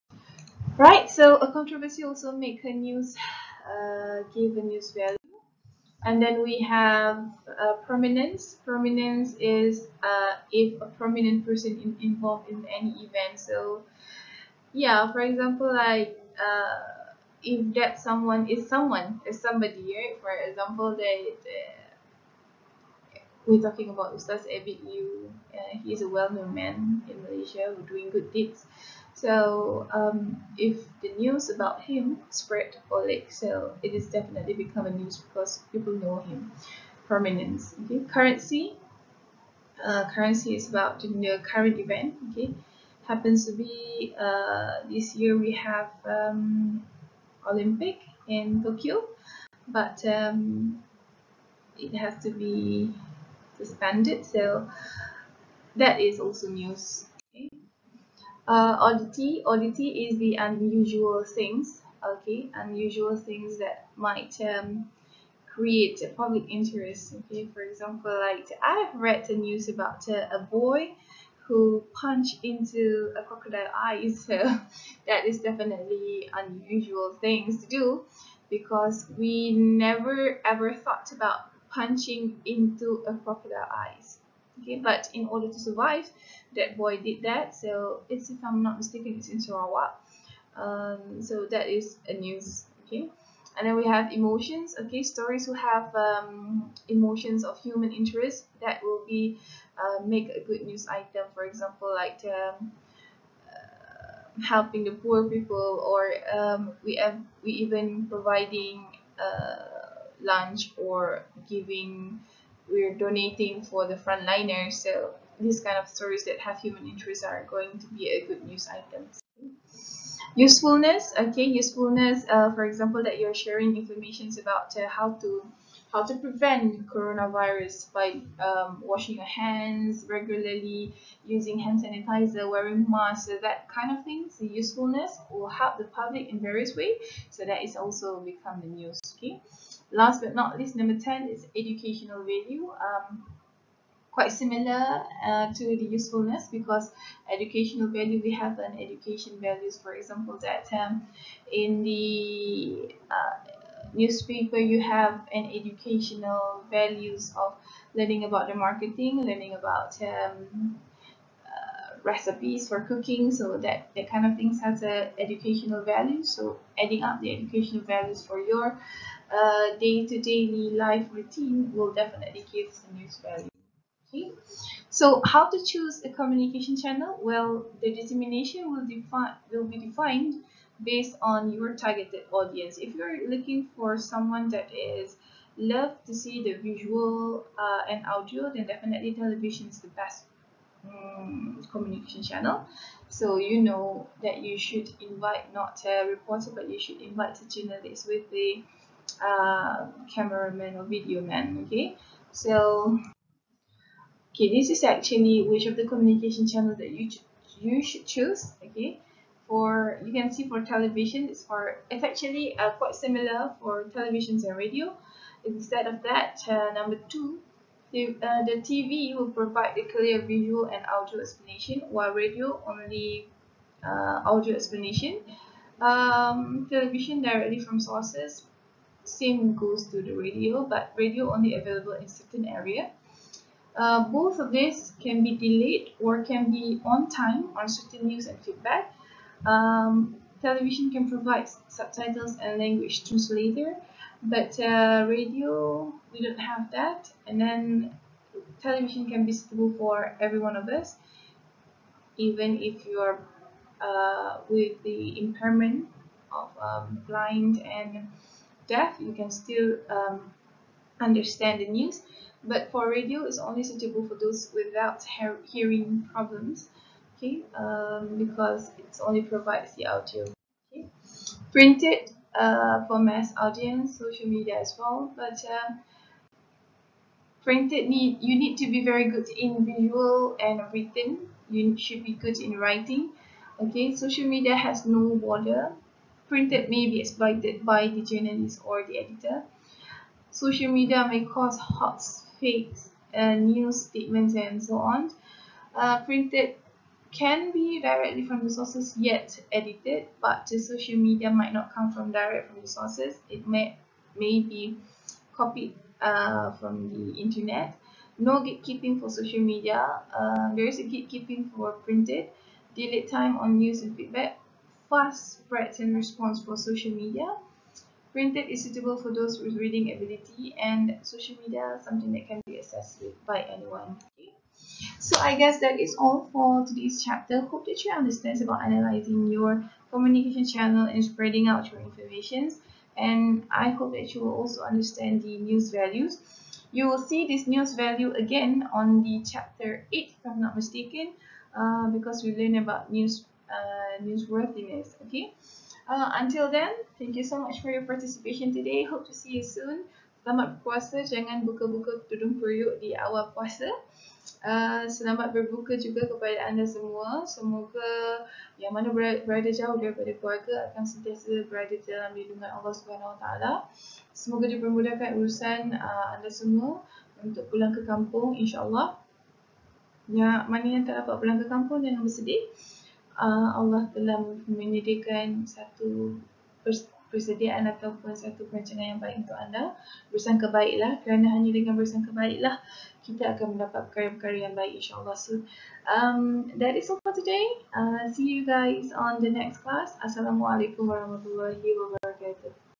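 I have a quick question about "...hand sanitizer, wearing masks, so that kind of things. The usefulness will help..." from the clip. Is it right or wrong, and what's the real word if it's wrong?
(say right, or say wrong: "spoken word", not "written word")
right.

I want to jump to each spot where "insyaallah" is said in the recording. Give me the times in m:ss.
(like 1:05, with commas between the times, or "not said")
6:08, 6:24.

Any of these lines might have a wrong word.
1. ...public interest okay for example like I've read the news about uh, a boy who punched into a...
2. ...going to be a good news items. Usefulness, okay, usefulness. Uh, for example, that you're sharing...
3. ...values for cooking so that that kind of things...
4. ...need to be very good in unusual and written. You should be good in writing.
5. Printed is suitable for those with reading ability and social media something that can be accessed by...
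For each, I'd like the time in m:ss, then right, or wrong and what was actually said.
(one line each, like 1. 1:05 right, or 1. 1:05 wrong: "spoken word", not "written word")
1. 1:06 right
2. 1:57 right
3. 2:42 wrong: "recipes", not "values"
4. 4:38 wrong: "visual", not "unusual"
5. 5:18 right.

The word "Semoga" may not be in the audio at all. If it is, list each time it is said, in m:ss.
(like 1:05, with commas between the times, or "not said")
5:57, 6:04.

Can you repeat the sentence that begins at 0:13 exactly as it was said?
So, yeah, for example, like uh, if that someone is someone, is somebody, right?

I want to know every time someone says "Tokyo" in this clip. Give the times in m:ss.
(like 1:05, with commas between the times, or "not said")
0:48.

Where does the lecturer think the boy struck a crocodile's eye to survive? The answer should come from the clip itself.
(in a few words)
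Sarawak.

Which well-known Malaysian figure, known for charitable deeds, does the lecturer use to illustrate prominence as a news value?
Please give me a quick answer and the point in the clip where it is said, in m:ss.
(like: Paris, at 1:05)
Ustaz Ebit Lew, at 0:24.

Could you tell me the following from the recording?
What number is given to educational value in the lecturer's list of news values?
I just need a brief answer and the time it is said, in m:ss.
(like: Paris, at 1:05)
10, at 2:20.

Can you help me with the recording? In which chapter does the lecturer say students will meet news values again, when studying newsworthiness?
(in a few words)
chapter 8.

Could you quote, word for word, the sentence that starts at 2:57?
Well, the determination will, define, will be defined based on your targeted audience.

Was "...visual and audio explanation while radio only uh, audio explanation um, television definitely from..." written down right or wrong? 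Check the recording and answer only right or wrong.
wrong.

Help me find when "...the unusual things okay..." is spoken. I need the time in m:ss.
1:00.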